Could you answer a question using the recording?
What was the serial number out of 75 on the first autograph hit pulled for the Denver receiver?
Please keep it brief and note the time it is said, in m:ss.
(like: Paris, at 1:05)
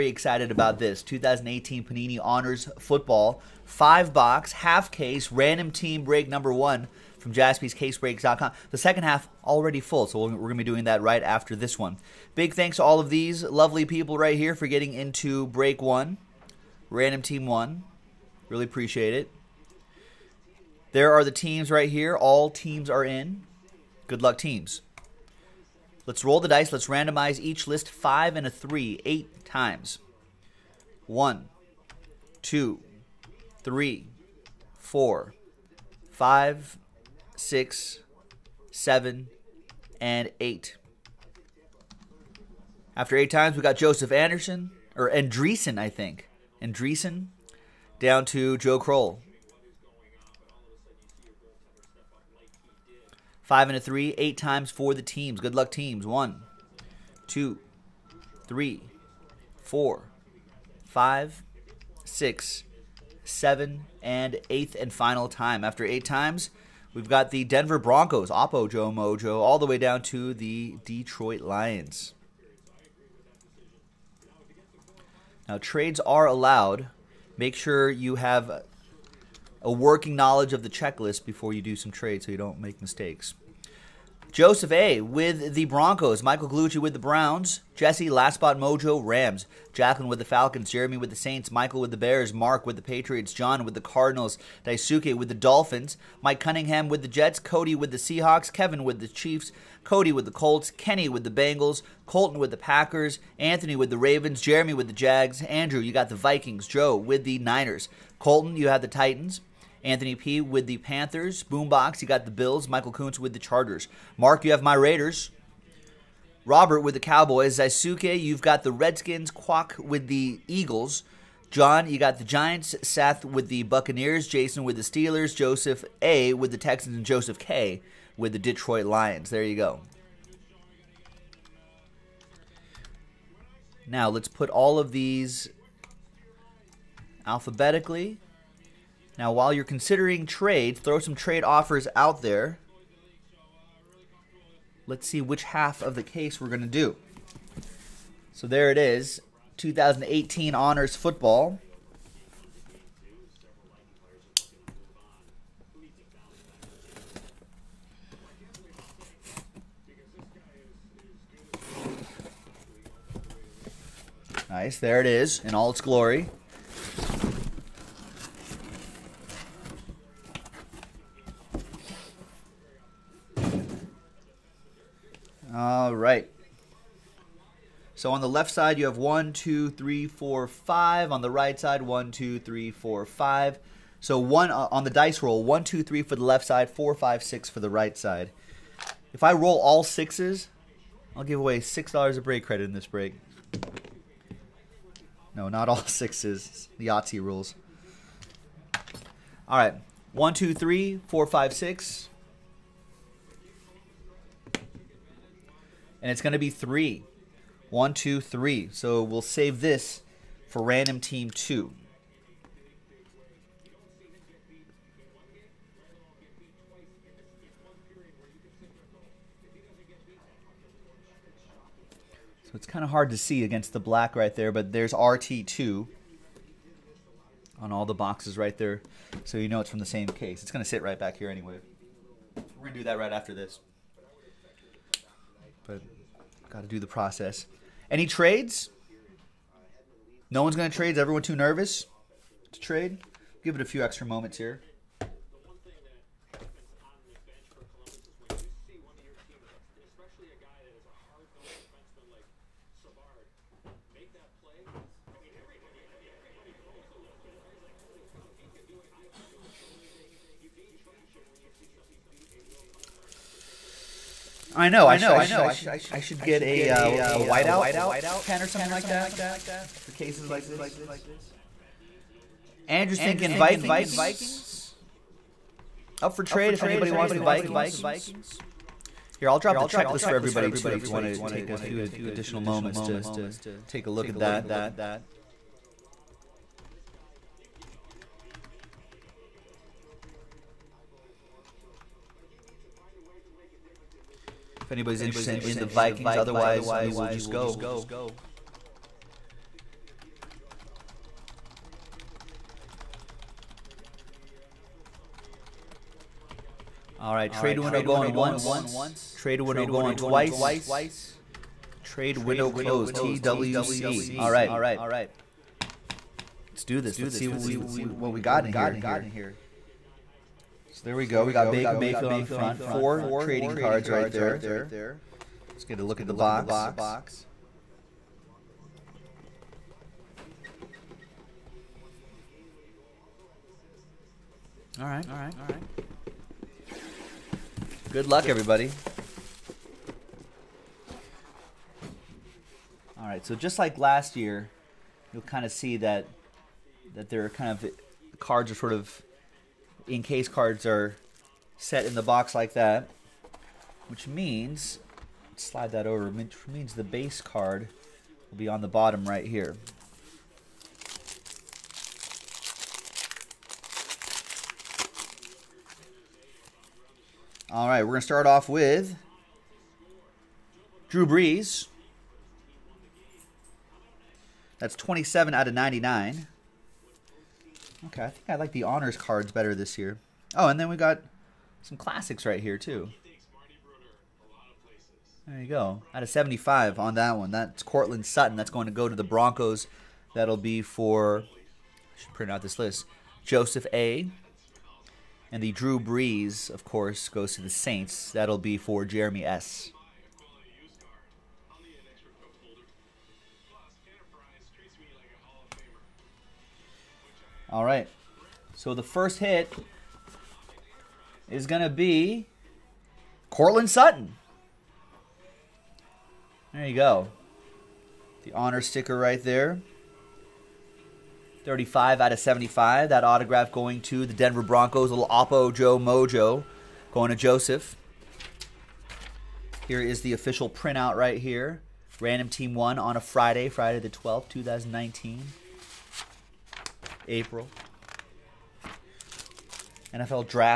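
35, at 7:01.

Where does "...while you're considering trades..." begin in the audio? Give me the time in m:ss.
2:19.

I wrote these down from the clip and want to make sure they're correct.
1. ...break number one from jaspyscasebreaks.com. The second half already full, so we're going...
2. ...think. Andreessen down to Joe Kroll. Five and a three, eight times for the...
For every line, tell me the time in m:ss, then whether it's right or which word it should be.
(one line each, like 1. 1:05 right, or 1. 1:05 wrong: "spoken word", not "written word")
1. 0:06 right
2. 0:45 right.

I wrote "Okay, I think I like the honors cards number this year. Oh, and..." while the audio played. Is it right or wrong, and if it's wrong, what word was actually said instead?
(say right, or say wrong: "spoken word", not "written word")
wrong: "better", not "number".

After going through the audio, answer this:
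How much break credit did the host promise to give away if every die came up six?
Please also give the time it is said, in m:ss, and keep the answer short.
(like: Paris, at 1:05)
six dollars, at 3:11.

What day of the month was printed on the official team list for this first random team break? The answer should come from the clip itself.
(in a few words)
12th.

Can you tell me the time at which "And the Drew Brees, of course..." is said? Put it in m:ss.
6:35.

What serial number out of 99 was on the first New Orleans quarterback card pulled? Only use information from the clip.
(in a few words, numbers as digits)
27.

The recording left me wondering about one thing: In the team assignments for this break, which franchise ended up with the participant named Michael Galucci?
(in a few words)
Browns.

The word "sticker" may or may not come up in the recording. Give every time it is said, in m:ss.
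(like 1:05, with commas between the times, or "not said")
6:58.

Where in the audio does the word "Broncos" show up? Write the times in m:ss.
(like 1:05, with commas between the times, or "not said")
1:07, 1:25, 6:29, 7:04.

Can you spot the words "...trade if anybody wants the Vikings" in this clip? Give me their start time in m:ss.
4:36.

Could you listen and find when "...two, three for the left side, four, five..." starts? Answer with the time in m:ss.
3:05.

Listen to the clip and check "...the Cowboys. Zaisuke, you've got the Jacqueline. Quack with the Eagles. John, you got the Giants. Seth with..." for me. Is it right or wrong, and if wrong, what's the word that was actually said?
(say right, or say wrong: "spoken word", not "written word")
wrong: "Redskins", not "Jacqueline".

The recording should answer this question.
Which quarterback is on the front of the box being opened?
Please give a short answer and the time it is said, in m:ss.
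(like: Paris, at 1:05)
Baker Mayfield, at 5:21.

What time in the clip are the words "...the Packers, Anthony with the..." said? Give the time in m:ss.
1:42.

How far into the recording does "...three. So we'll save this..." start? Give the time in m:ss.
3:28.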